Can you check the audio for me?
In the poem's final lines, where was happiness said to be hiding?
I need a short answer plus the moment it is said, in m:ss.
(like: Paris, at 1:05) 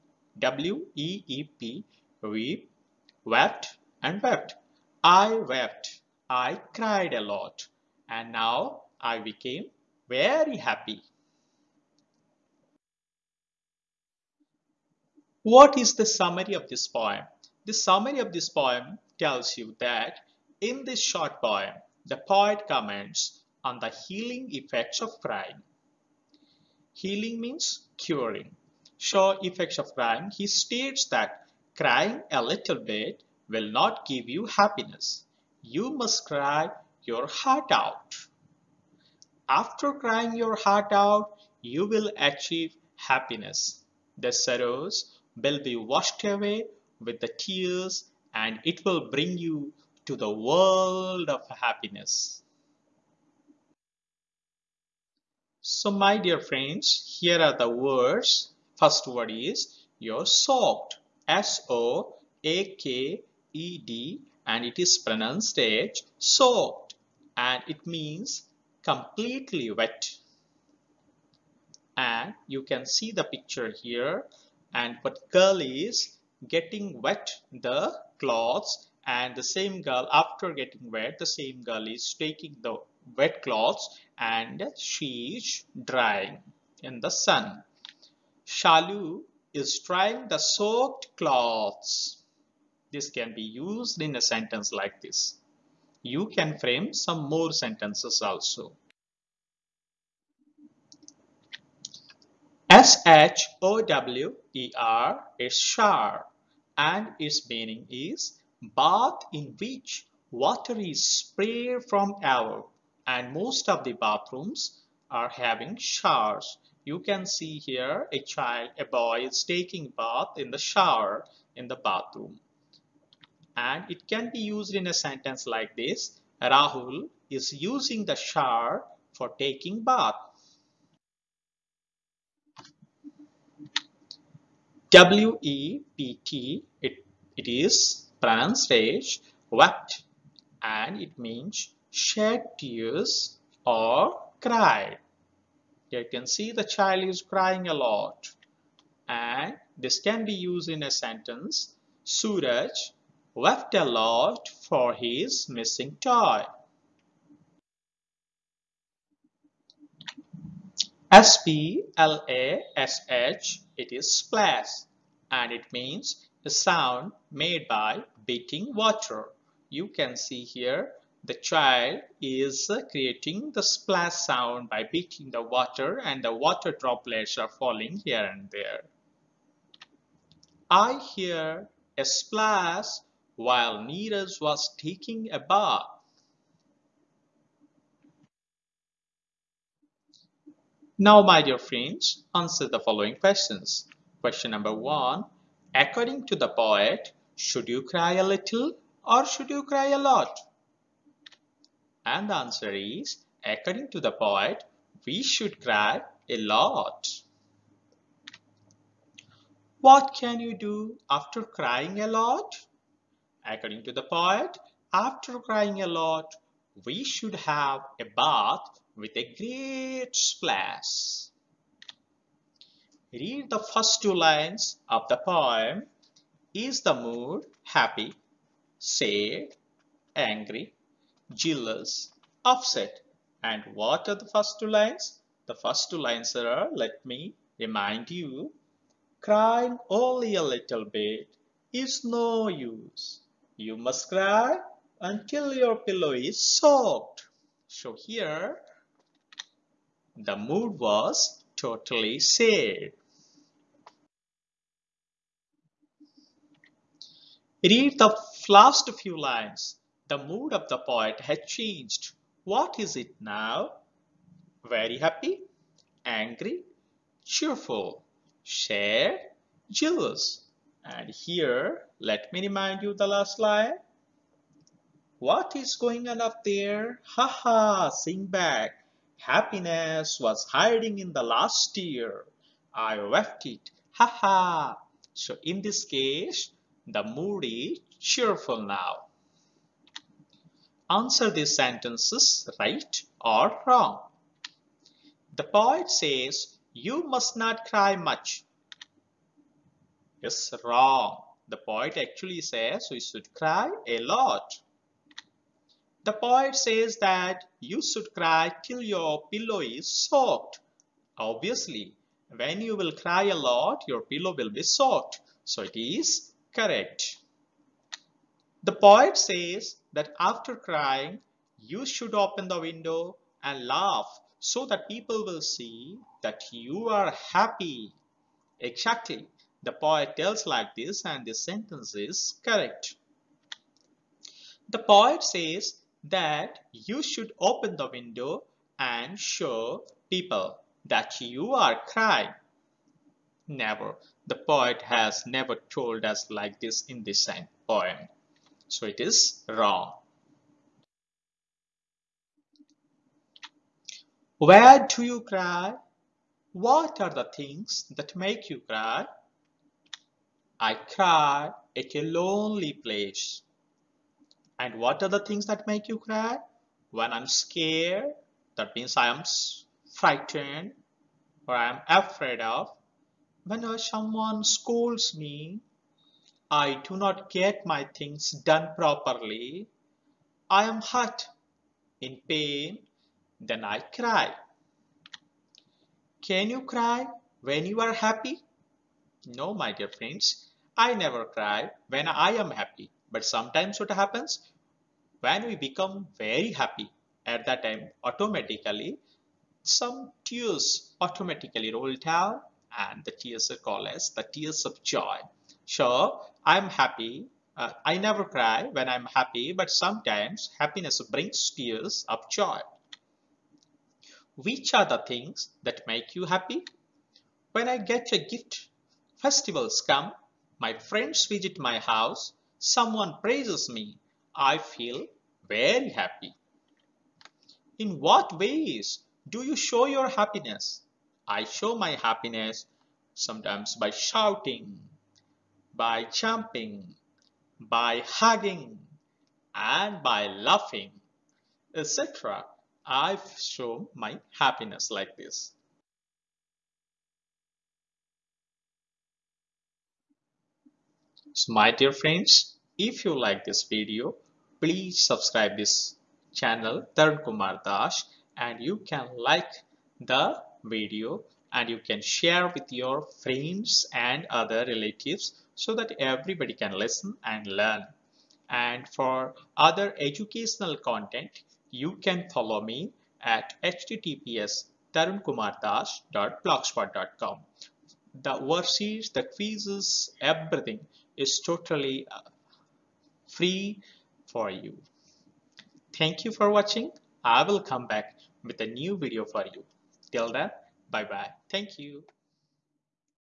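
in the last tear, at 4:41.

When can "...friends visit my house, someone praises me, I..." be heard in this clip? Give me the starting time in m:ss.
7:00.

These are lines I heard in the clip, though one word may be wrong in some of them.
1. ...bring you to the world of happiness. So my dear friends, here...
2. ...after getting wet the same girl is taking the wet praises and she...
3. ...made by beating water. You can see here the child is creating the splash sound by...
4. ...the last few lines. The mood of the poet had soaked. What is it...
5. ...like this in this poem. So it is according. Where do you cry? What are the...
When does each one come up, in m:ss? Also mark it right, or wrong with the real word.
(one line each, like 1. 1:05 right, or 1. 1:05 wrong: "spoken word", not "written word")
1. 0:49 right
2. 1:20 wrong: "clothes", not "praises"
3. 2:47 right
4. 4:17 wrong: "changed", not "soaked"
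5. 5:46 wrong: "wrong", not "according".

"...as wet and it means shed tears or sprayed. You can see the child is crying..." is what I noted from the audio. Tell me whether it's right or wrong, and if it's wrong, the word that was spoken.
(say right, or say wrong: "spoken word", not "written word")
wrong: "cried", not "sprayed".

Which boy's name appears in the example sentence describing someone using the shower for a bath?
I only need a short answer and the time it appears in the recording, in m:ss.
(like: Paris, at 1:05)
Rahul, at 2:06.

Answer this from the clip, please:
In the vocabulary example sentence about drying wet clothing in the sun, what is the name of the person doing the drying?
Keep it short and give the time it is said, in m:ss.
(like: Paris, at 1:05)
Shalu, at 1:28.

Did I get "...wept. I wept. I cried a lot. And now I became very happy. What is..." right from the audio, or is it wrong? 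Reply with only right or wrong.
right.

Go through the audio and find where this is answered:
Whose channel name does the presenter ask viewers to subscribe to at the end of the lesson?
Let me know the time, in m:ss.
7:36.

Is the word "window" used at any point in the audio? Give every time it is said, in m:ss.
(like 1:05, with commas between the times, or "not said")
5:22, 5:37.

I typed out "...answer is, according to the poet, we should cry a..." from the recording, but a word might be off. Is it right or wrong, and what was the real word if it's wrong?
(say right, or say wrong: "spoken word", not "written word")
right.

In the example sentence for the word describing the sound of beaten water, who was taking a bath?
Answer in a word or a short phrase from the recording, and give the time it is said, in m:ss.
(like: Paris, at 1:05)
Neeraj, at 3:03.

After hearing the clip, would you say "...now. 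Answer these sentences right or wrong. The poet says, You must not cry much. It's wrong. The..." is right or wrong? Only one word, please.
right.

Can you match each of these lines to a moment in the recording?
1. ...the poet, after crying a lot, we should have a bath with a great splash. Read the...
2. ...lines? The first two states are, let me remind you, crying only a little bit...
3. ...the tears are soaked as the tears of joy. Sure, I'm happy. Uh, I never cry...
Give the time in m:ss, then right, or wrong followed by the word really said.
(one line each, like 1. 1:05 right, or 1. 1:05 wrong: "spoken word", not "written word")
1. 3:33 right
2. 3:54 wrong: "lines", not "states"
3. 6:43 wrong: "called", not "soaked".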